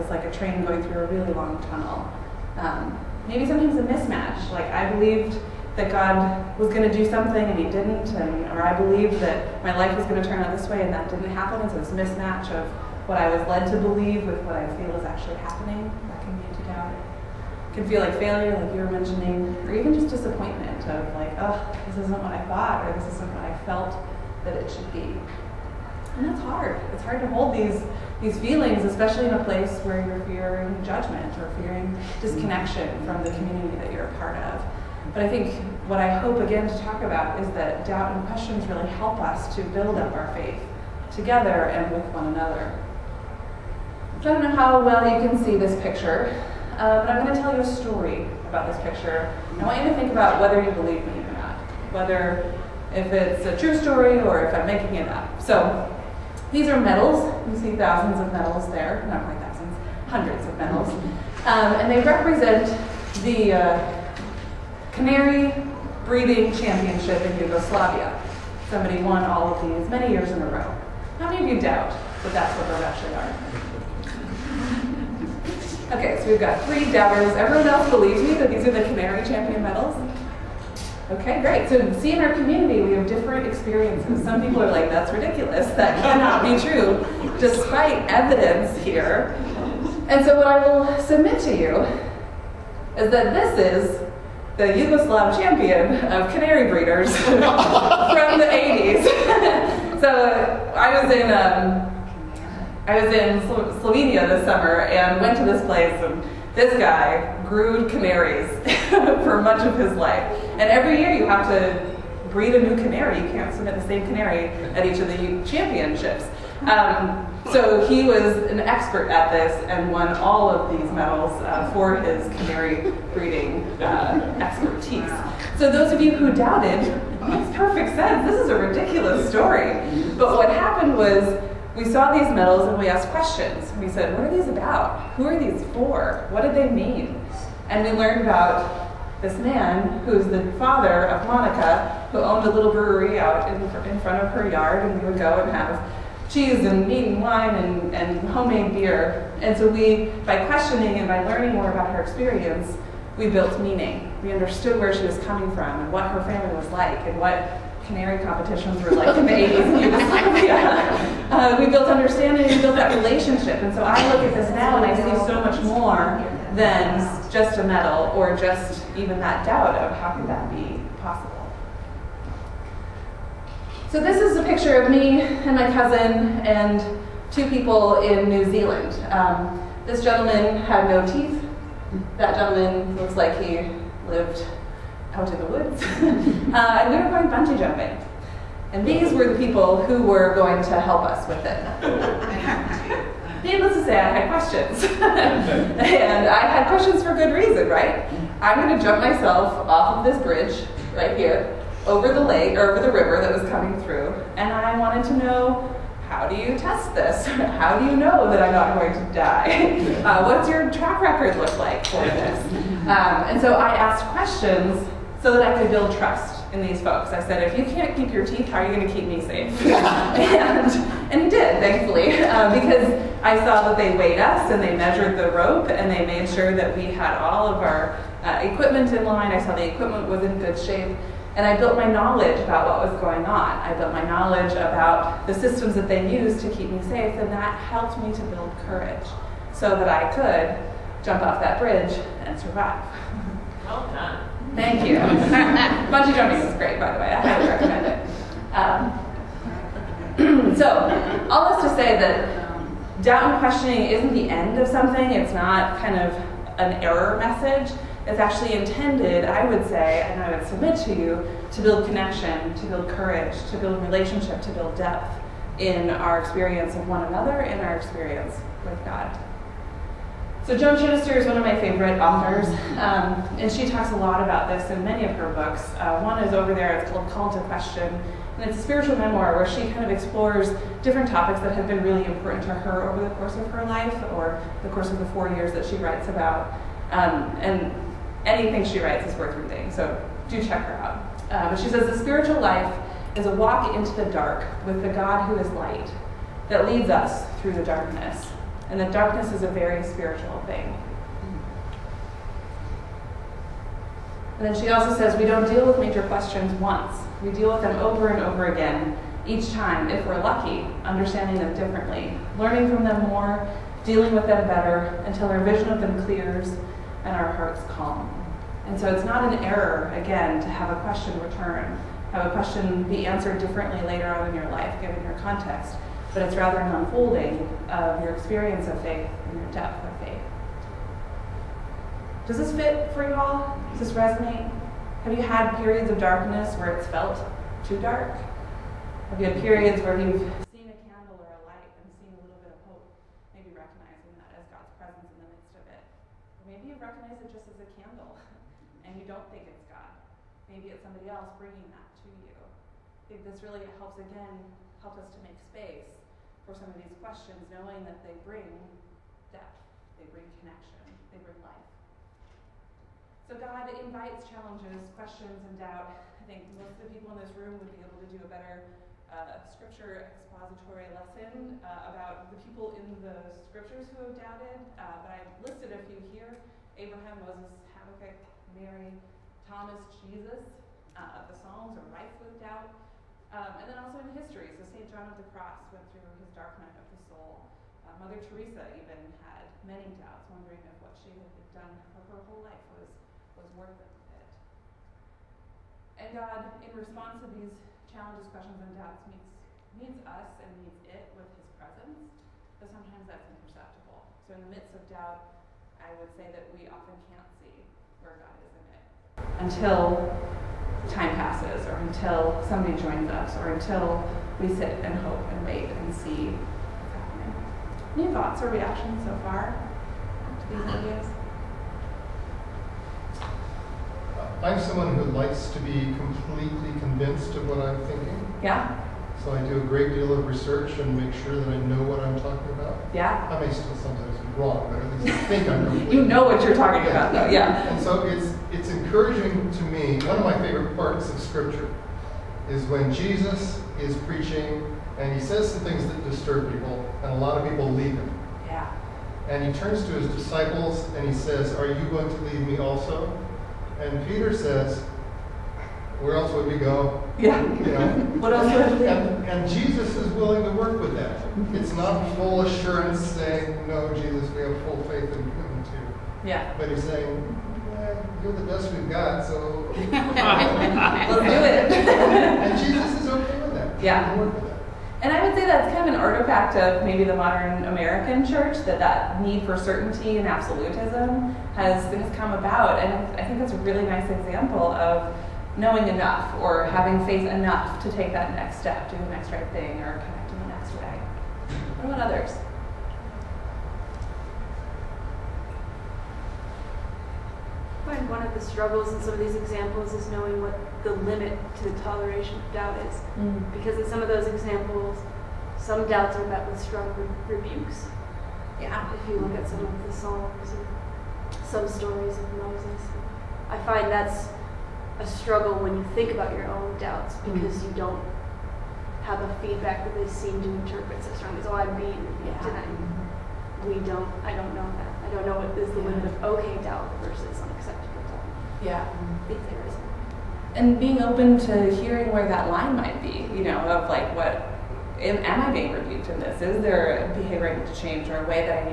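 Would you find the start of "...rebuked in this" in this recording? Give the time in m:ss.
8:55.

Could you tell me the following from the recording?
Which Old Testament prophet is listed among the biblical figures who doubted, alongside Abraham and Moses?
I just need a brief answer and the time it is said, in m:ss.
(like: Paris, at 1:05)
Habakkuk, at 6:17.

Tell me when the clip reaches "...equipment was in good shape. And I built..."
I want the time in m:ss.
3:49.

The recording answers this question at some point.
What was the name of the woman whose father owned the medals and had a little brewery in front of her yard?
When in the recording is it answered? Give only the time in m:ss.
2:21.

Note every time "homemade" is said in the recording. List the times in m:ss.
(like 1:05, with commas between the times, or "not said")
2:28.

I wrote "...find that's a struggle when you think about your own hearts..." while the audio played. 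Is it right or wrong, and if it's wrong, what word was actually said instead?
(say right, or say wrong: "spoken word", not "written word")
wrong: "doubts", not "hearts".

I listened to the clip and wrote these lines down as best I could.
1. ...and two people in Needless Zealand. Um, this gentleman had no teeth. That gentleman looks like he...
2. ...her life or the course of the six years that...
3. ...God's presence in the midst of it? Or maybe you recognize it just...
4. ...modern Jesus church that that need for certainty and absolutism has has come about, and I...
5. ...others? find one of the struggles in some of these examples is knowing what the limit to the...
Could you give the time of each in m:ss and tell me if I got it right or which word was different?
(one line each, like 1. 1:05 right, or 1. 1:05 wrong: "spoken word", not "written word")
1. 2:56 wrong: "New", not "Needless"
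2. 4:43 wrong: "four", not "six"
3. 5:44 right
4. 7:57 wrong: "American", not "Jesus"
5. 8:12 right.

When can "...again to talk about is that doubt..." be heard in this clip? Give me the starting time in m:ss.
0:36.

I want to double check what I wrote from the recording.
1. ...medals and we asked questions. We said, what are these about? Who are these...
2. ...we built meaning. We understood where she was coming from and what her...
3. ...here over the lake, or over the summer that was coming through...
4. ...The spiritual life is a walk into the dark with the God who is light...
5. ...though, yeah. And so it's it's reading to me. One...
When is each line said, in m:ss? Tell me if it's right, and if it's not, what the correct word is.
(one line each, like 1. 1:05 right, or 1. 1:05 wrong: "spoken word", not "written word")
1. 2:12 right
2. 2:33 right
3. 3:21 wrong: "river", not "summer"
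4. 4:51 right
5. 7:17 wrong: "encouraging", not "reading".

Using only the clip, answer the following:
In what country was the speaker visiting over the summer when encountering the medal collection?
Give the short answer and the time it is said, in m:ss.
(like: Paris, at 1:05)
Slovenia, at 1:43.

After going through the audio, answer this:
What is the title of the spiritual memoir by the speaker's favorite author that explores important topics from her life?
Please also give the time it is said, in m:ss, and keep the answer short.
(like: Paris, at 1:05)
Call to Question, at 4:37.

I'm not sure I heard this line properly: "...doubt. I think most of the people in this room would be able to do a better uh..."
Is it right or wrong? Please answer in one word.
right.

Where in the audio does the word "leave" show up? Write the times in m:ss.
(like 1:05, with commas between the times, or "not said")
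7:27, 7:32.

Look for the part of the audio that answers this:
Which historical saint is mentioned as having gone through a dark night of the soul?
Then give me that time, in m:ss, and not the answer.
6:24.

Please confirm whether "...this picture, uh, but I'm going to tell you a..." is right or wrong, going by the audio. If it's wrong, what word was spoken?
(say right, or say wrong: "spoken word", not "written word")
right.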